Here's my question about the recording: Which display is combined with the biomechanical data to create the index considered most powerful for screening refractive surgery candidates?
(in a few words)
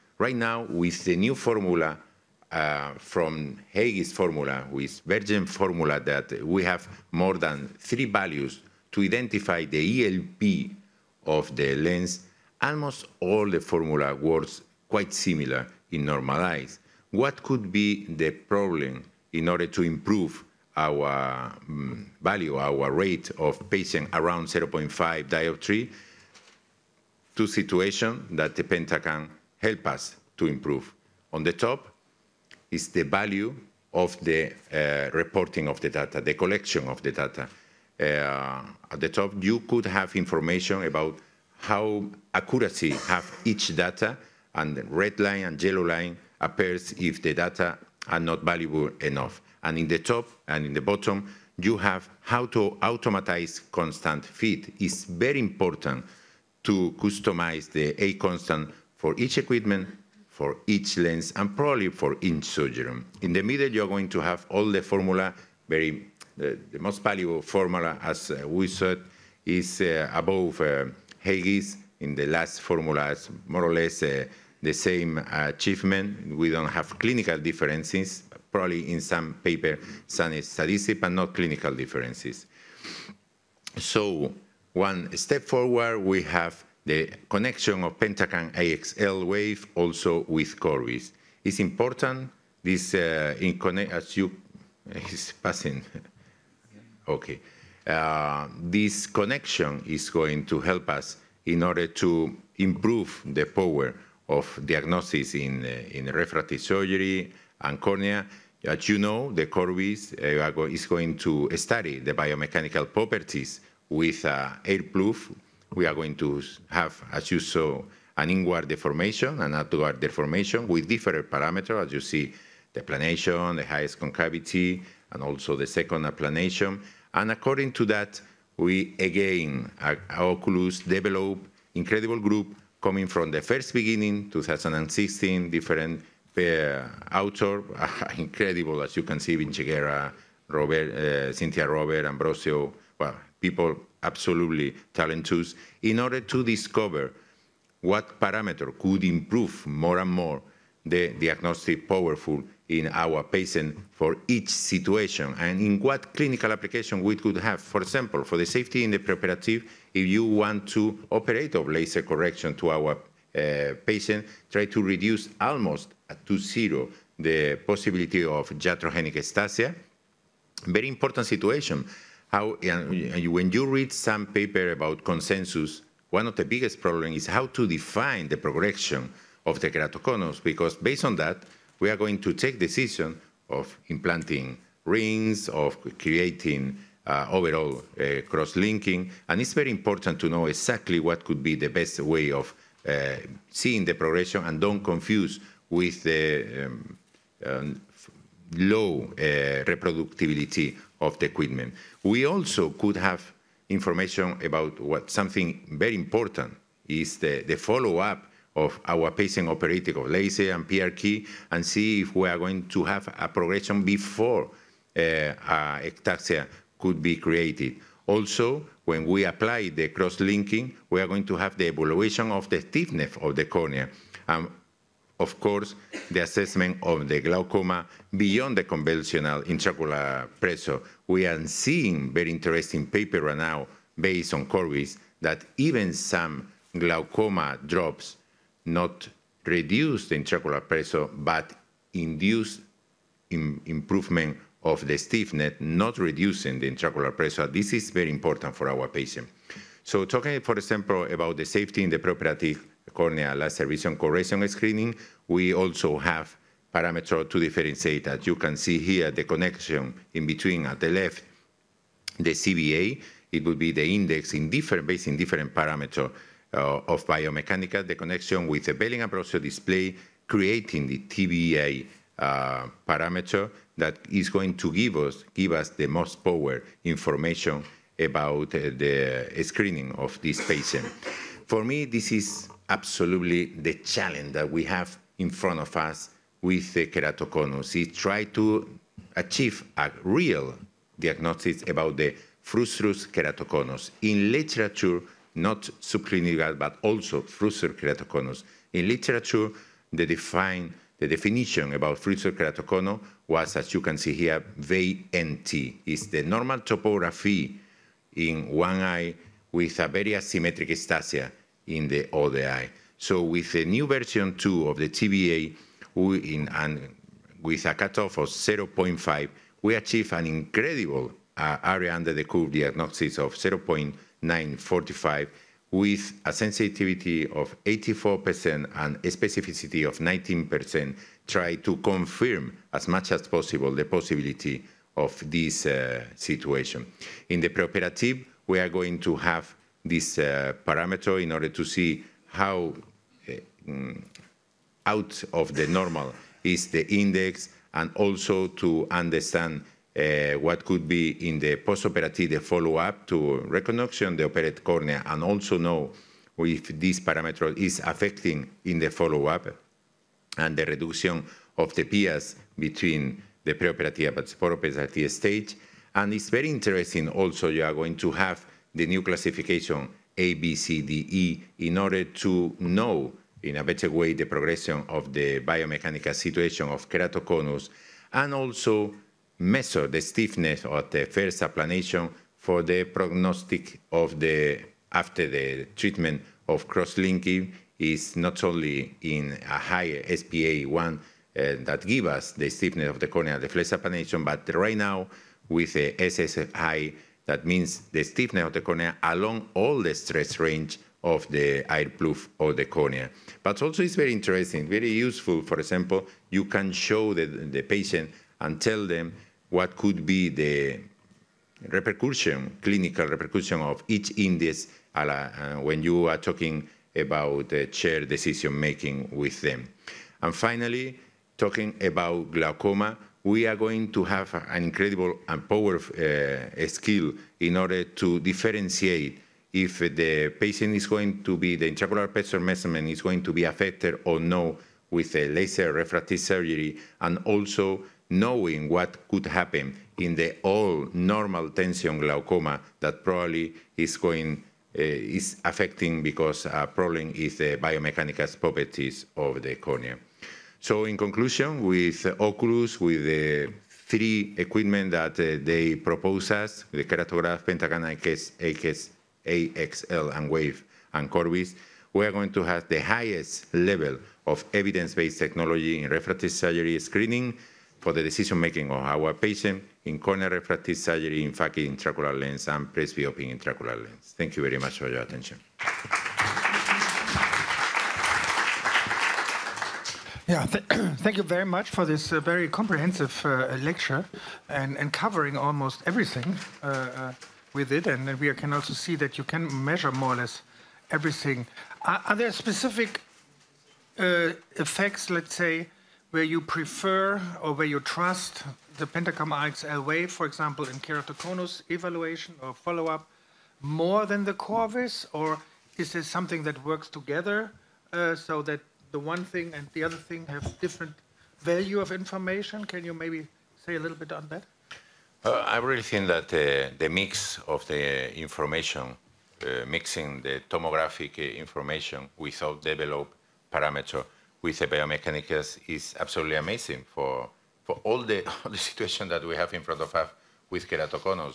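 Belin Ambrosio display.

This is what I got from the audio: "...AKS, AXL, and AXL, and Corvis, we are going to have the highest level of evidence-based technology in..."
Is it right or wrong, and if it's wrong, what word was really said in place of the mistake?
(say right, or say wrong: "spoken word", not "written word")
wrong: "WAVE", not "AXL".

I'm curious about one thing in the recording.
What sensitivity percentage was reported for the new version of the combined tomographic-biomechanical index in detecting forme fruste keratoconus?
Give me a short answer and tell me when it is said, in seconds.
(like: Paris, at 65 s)
84%, at 327 s.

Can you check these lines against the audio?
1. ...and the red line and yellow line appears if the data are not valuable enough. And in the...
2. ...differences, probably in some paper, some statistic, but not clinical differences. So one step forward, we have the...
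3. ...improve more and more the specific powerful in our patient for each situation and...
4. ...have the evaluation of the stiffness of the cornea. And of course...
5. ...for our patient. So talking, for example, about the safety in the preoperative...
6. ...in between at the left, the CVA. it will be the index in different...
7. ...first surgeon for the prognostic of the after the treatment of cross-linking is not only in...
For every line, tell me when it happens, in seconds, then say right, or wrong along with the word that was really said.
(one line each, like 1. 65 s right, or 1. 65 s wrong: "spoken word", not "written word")
1. 44 s right
2. 77 s right
3. 149 s wrong: "diagnostic", not "specific"
4. 221 s right
5. 248 s right
6. 260 s right
7. 381 s wrong: "applanation", not "surgeon".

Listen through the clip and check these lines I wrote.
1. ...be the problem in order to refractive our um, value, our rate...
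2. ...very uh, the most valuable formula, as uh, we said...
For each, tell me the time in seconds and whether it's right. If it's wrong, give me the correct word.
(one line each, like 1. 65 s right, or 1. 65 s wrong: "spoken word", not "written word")
1. 17 s wrong: "improve", not "refractive"
2. 65 s right.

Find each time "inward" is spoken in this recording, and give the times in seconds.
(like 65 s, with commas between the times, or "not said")
118 s.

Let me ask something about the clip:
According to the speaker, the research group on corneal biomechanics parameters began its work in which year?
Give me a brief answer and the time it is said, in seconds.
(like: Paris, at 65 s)
2016, at 134 s.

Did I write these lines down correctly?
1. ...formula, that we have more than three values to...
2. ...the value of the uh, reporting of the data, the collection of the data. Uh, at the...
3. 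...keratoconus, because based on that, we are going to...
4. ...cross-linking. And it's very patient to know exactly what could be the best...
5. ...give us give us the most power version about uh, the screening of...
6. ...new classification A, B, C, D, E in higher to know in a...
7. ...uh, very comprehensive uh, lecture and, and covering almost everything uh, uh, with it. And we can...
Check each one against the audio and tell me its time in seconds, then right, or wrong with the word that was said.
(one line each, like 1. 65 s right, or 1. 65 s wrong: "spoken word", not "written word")
1. 5 s right
2. 32 s right
3. 179 s right
4. 188 s wrong: "important", not "patient"
5. 274 s wrong: "information", not "version"
6. 368 s wrong: "order", not "higher"
7. 482 s right.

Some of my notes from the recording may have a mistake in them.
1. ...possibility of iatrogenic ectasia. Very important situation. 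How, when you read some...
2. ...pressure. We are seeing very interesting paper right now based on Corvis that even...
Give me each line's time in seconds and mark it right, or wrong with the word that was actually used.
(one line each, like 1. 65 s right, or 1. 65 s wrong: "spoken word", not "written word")
1. 167 s right
2. 230 s right.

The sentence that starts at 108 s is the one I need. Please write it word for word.
As you know, the Corvis eh, is going to study the biomechanical properties with uh, eh, air puff.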